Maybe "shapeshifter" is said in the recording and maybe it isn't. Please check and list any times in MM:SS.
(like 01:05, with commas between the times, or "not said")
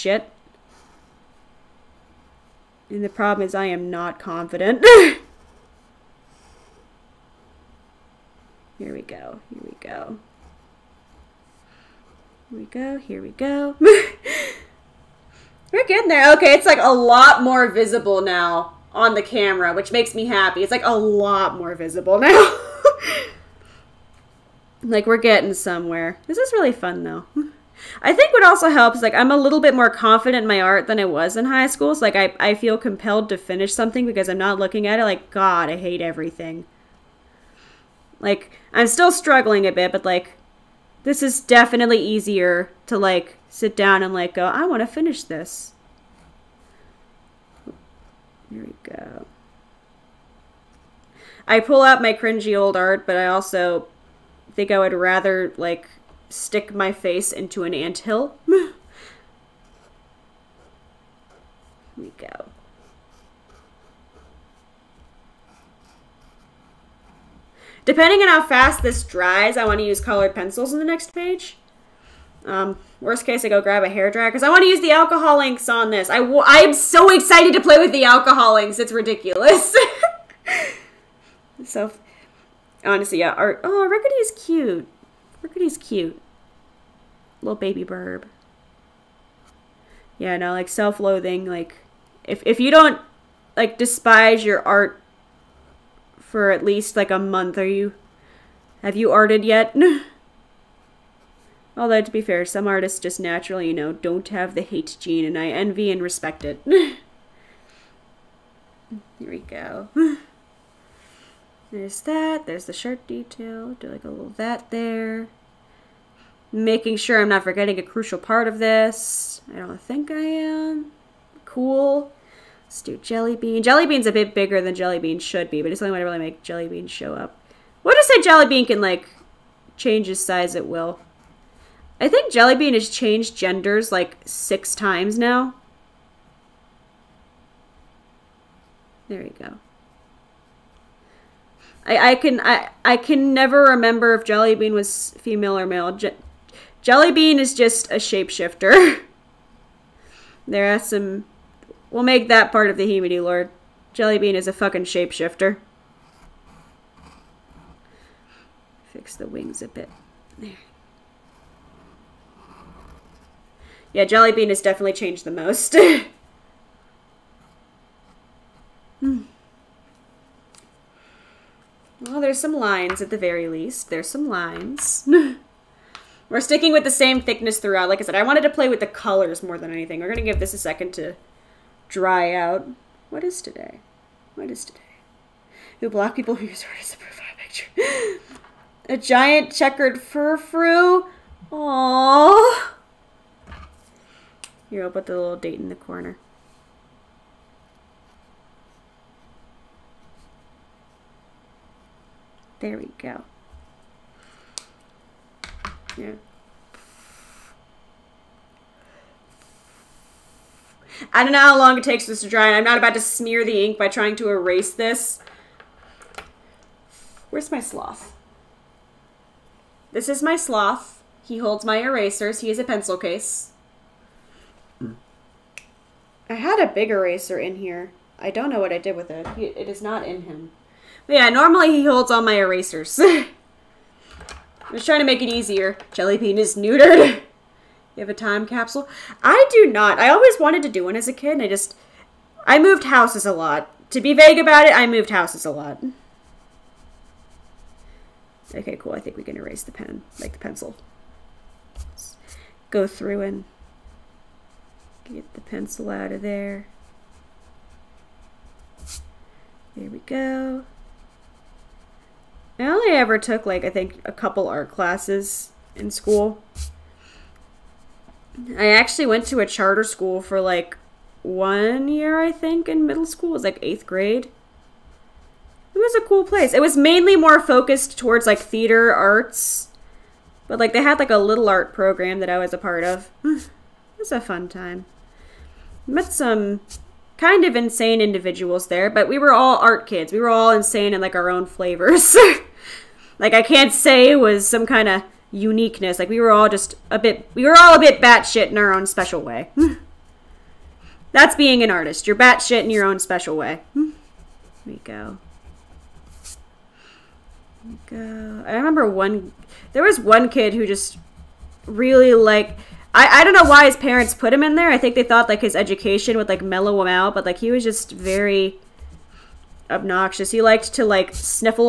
02:27, 02:34.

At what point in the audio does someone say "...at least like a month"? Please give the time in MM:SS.
01:36.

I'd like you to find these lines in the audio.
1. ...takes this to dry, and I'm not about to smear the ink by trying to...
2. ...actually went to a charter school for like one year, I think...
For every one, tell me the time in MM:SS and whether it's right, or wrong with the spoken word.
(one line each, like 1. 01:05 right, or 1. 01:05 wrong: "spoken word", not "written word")
1. 03:31 right
2. 04:28 right.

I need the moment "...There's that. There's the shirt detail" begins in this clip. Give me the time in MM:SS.
01:51.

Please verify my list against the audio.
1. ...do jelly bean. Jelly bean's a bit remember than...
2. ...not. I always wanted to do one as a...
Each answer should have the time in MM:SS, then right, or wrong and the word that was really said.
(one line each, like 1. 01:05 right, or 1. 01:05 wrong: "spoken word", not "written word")
1. 02:02 wrong: "bigger", not "remember"
2. 03:59 right.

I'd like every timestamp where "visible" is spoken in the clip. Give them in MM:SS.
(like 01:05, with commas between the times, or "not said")
00:17, 00:21.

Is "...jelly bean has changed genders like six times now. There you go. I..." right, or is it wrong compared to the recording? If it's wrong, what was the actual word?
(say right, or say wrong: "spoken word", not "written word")
right.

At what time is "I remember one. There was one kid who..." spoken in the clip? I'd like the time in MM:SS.
05:08.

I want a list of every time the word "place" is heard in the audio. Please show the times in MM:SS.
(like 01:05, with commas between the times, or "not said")
04:36.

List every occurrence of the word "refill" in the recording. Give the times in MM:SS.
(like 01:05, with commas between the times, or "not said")
not said.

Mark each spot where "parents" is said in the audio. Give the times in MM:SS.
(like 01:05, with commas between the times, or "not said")
05:13.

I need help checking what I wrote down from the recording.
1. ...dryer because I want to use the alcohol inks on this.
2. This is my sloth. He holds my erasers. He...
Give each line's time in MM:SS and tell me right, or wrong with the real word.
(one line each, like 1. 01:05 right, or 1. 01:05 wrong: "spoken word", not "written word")
1. 01:14 right
2. 03:39 right.